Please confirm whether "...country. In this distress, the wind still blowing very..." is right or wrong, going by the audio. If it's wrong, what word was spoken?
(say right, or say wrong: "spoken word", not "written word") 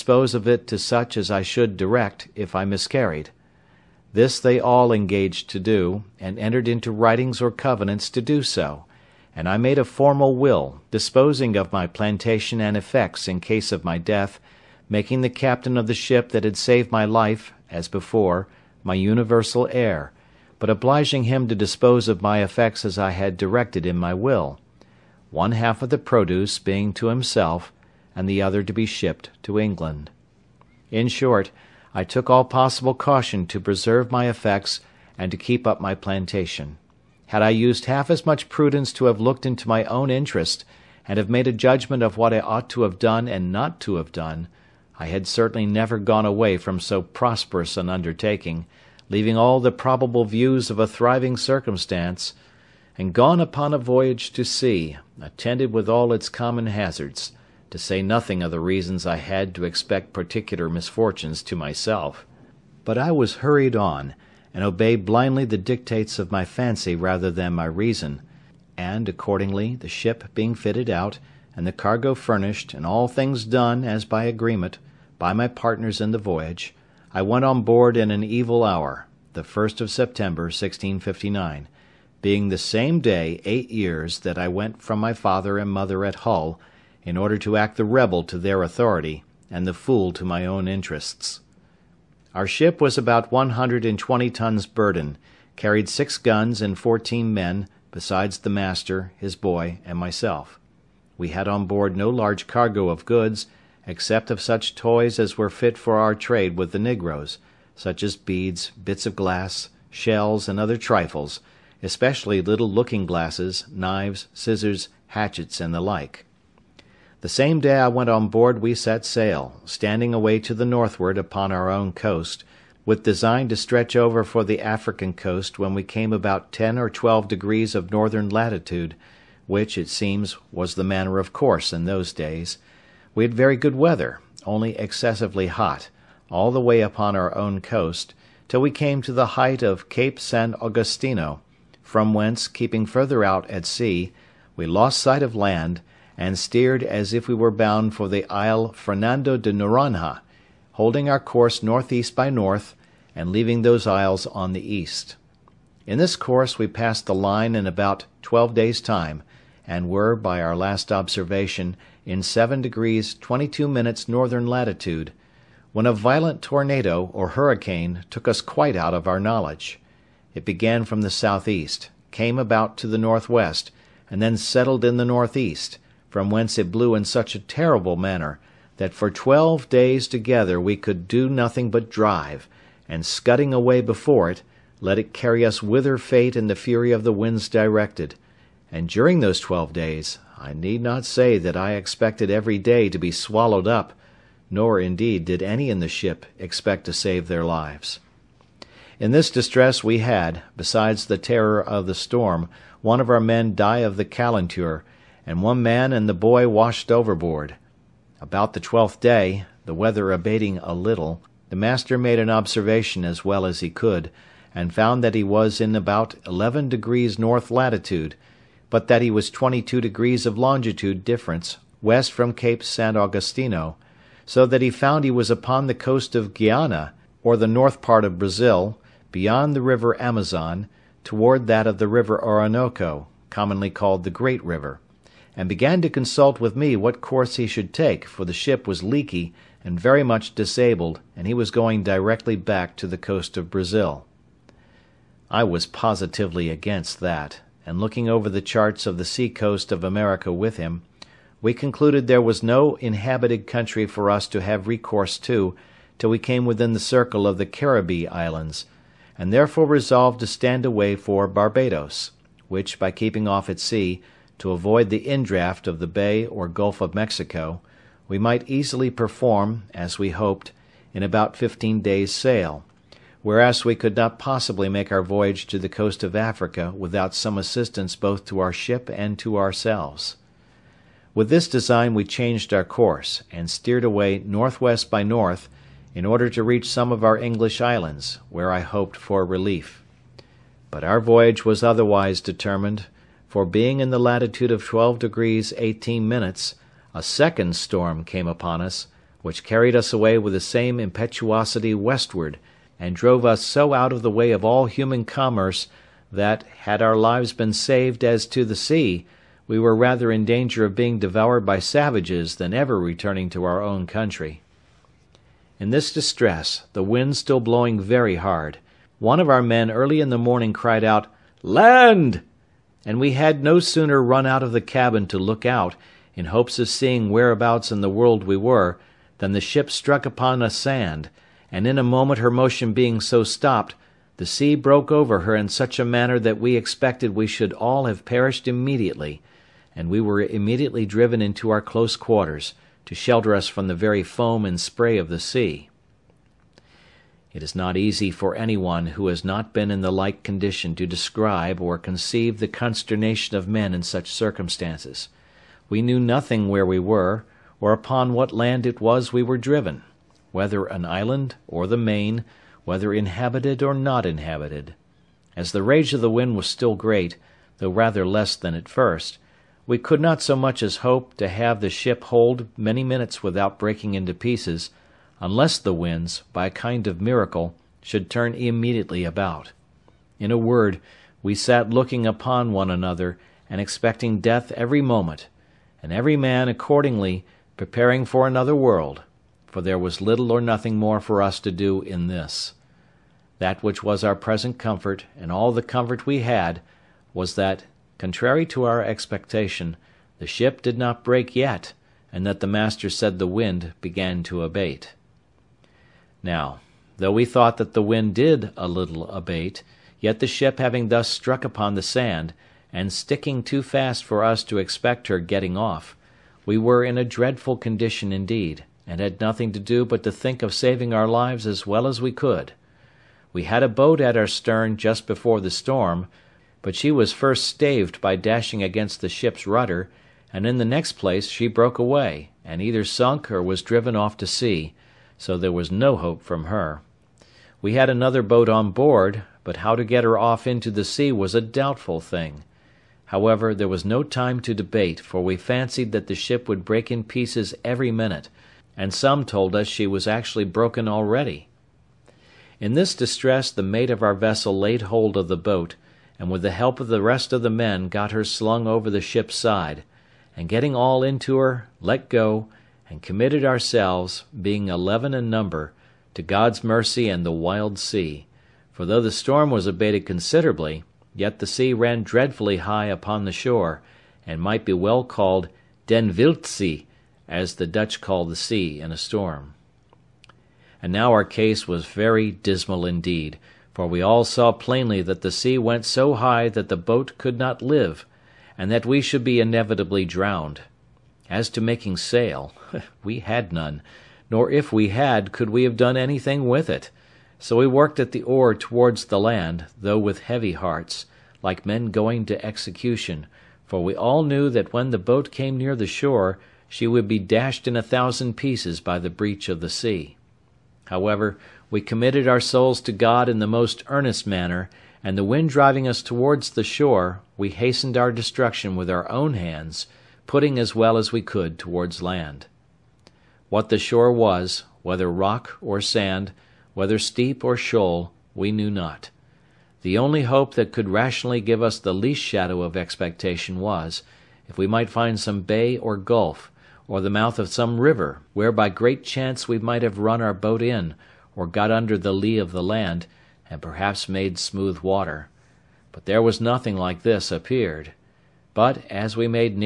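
right.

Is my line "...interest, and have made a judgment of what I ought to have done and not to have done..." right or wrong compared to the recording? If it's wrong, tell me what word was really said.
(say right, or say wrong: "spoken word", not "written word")
right.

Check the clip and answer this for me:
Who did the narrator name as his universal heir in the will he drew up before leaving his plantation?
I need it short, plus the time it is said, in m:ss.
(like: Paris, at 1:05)
The captain of the ship, at 0:15.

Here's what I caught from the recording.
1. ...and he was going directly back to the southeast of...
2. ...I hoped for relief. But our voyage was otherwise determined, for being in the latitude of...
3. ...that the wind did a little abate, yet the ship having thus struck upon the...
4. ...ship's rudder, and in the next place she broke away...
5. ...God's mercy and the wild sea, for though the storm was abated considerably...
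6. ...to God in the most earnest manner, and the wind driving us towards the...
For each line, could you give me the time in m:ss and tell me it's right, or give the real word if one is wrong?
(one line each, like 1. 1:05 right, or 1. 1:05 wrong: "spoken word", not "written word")
1. 4:01 wrong: "coast", not "southeast"
2. 4:48 right
3. 6:47 right
4. 7:09 right
5. 7:46 right
6. 8:32 right.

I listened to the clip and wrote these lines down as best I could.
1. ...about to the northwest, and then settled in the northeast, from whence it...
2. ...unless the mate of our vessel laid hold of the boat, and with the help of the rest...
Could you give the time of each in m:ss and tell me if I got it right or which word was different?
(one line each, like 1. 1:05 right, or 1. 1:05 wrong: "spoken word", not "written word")
1. 2:52 right
2. 7:32 wrong: "distress", not "unless".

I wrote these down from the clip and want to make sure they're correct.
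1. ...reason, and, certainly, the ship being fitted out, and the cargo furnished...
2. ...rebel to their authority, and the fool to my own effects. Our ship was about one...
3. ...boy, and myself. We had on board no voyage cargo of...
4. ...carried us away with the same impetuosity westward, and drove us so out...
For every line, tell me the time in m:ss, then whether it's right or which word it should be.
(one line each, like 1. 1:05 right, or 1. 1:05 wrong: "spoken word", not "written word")
1. 1:07 wrong: "accordingly", not "certainly"
2. 1:27 wrong: "interests", not "effects"
3. 1:39 wrong: "large", not "voyage"
4. 4:59 right.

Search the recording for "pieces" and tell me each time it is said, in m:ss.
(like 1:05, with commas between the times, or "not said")
6:14, 7:27, 8:28.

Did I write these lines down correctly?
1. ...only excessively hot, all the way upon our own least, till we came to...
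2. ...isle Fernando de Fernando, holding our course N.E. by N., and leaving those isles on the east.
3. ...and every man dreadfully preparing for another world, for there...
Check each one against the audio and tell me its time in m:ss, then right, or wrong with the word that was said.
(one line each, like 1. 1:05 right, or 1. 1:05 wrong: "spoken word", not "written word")
1. 2:14 wrong: "coast", not "least"
2. 2:28 wrong: "Noronha", not "Fernando"
3. 6:25 wrong: "accordingly", not "dreadfully".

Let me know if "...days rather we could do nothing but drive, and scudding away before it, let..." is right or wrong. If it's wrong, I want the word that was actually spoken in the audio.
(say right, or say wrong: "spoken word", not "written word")
wrong: "together", not "rather".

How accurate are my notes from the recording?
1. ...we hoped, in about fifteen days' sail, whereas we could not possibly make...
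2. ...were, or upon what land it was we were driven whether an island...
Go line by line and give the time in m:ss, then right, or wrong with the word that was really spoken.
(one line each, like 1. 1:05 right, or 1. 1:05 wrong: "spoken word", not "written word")
1. 4:29 right
2. 5:56 right.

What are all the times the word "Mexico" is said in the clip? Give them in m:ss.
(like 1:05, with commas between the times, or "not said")
4:26.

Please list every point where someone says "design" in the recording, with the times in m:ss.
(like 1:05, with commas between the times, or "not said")
2:03, 4:41.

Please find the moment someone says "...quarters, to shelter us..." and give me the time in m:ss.
5:41.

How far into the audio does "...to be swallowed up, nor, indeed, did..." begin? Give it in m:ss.
3:12.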